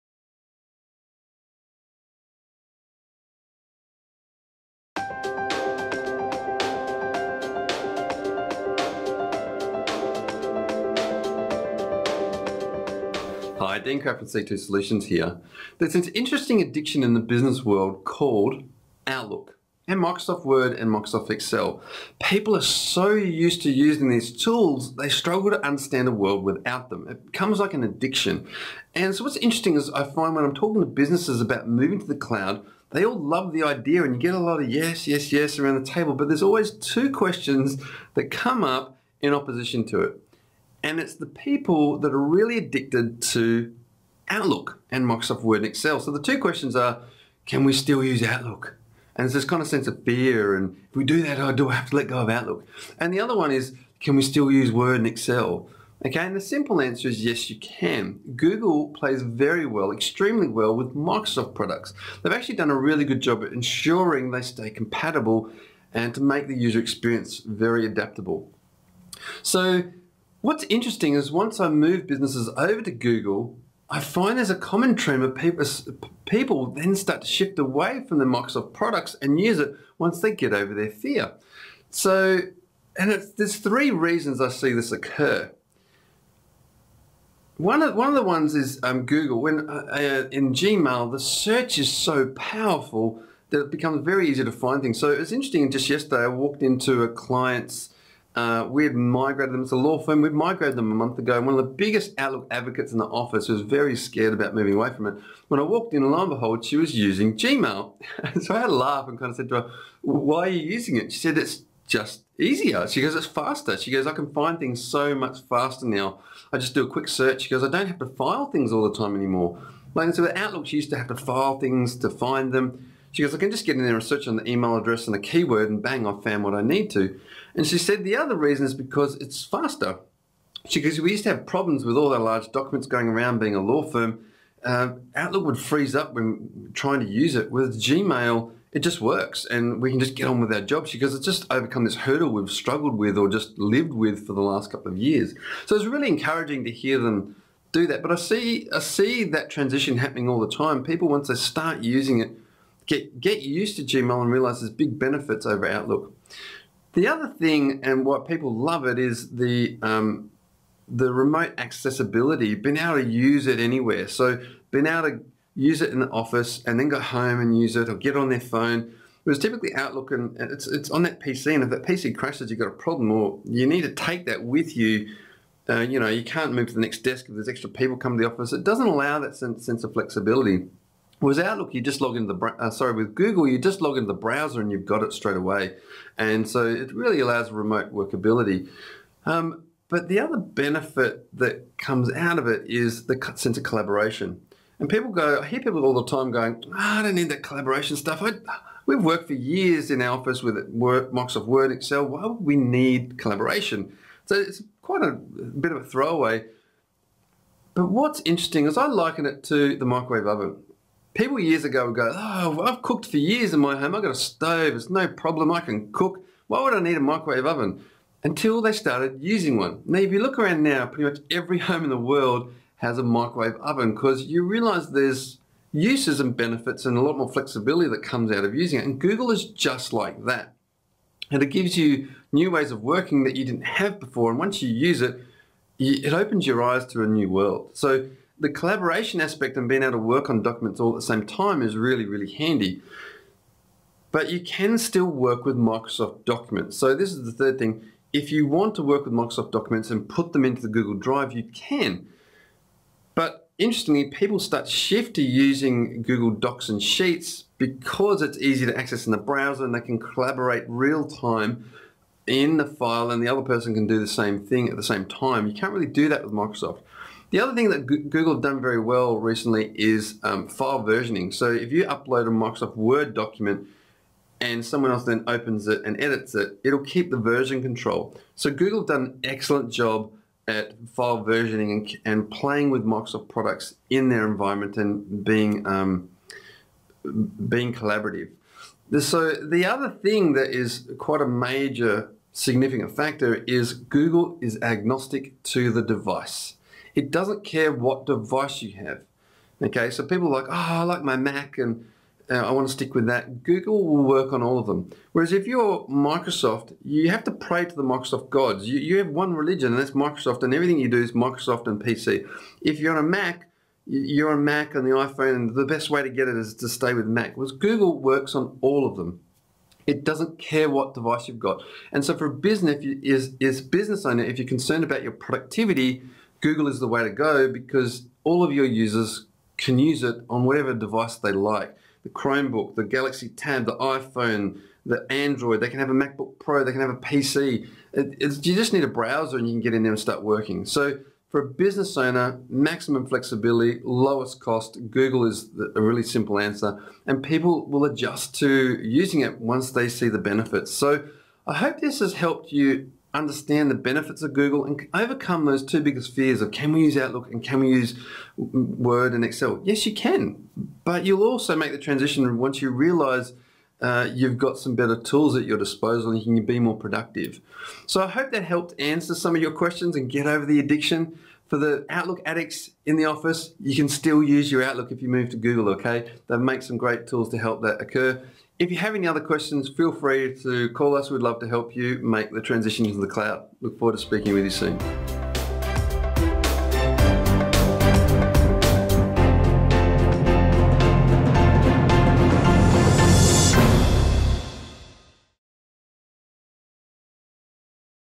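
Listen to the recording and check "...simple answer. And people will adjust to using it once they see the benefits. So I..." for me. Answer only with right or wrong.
right.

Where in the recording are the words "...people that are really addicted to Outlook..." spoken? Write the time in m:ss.
0:41.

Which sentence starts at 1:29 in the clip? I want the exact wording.
When uh, uh in Gmail, the search is so powerful that it becomes very easy to find things.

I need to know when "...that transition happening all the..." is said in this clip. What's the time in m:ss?
2:29.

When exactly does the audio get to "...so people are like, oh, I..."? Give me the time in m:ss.
4:59.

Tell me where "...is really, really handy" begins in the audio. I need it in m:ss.
4:01.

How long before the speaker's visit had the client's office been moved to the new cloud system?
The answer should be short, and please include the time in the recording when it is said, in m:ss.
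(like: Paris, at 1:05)
A month, at 1:40.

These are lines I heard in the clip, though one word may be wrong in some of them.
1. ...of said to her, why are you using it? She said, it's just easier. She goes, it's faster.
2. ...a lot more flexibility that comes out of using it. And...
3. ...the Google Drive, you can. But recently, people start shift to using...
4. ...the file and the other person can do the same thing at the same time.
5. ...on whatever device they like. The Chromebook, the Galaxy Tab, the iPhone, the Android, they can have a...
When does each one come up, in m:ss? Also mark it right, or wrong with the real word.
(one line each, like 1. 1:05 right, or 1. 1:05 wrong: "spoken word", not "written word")
1. 1:49 right
2. 3:46 right
3. 4:10 wrong: "interestingly", not "recently"
4. 4:22 right
5. 5:30 right.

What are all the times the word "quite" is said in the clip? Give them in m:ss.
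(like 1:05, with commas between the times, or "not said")
3:24, 4:50.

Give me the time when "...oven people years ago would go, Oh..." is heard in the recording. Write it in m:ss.
3:30.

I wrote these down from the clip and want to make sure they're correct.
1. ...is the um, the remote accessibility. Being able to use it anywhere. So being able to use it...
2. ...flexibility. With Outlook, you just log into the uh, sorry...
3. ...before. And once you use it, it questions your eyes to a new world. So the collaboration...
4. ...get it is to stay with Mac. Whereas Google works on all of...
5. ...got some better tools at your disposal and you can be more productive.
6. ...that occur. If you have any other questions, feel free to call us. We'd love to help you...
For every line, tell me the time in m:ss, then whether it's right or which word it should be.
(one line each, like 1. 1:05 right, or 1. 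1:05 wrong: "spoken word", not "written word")
1. 2:38 right
2. 2:59 right
3. 3:53 wrong: "opens", not "questions"
4. 5:16 right
5. 6:04 right
6. 6:17 right.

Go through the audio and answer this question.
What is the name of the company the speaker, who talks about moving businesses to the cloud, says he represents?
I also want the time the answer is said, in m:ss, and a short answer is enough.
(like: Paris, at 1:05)
C2 Solutions, at 0:14.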